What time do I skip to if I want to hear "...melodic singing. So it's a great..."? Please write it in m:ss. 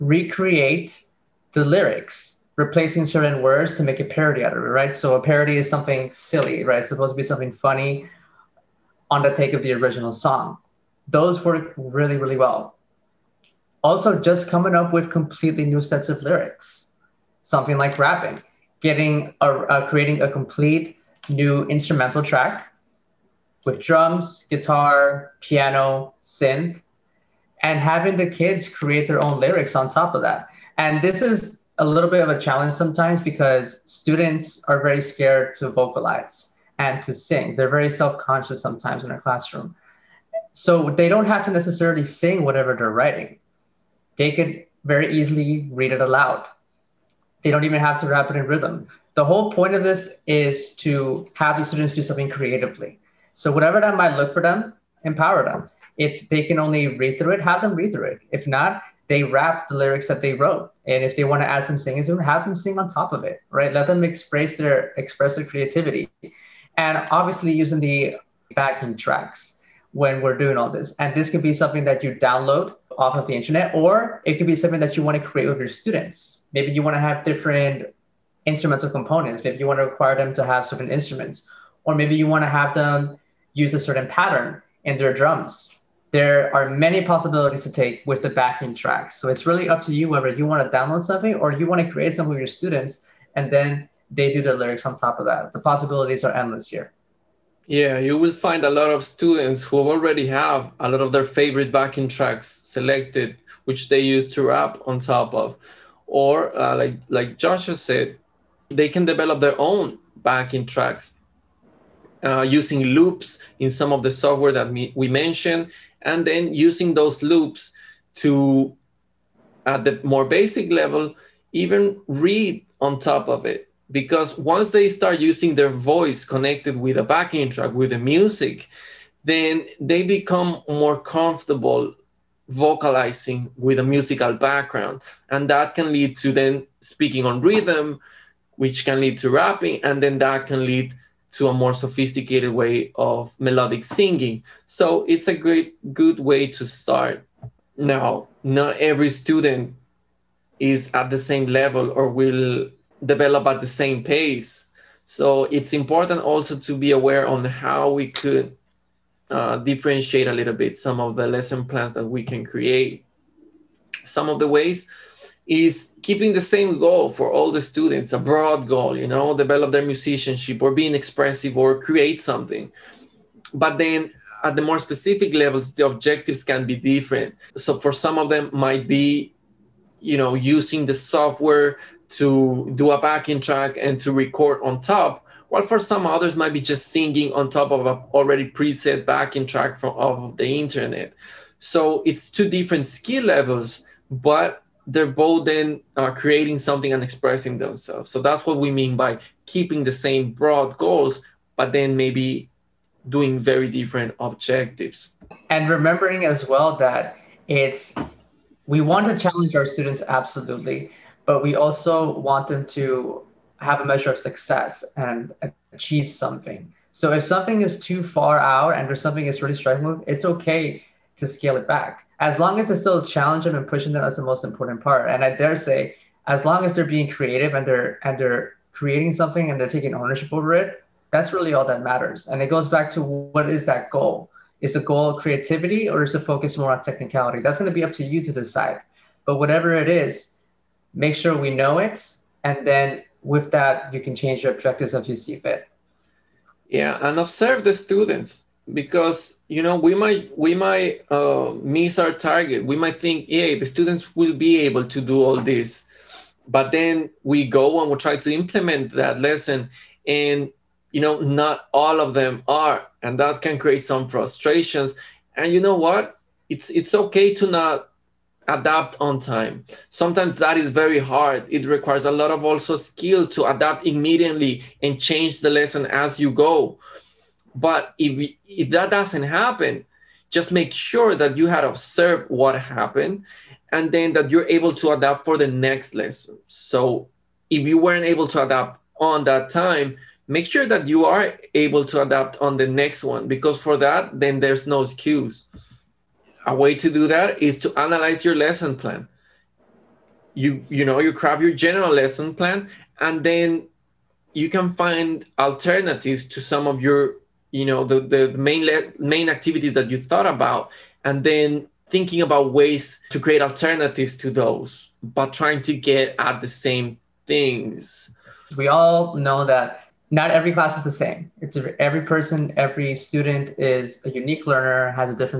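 2:23.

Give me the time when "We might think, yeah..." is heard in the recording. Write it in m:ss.
4:12.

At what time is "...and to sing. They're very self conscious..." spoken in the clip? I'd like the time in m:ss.
0:36.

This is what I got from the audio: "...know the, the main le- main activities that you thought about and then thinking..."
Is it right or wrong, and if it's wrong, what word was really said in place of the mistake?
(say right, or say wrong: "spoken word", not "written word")
right.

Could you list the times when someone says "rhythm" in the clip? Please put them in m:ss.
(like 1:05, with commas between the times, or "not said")
0:48, 2:17.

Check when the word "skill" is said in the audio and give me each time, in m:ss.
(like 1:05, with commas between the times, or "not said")
3:12, 4:32.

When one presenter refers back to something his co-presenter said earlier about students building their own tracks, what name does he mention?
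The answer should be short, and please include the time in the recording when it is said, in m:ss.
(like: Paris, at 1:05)
Joshua, at 1:47.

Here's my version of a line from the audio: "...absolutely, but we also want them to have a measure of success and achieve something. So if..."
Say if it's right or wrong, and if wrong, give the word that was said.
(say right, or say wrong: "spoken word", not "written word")
right.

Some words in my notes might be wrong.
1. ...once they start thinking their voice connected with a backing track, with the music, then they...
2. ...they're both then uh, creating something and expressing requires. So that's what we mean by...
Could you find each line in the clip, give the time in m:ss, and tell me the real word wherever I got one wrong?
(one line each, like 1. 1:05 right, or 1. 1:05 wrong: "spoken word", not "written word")
1. 2:04 wrong: "using", not "thinking"
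2. 3:14 wrong: "themselves", not "requires".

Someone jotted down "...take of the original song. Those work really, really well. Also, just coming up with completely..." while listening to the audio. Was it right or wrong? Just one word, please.
right.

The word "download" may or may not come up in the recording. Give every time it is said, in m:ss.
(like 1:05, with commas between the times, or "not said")
1:12, 1:30.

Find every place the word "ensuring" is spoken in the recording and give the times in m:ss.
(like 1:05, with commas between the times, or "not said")
not said.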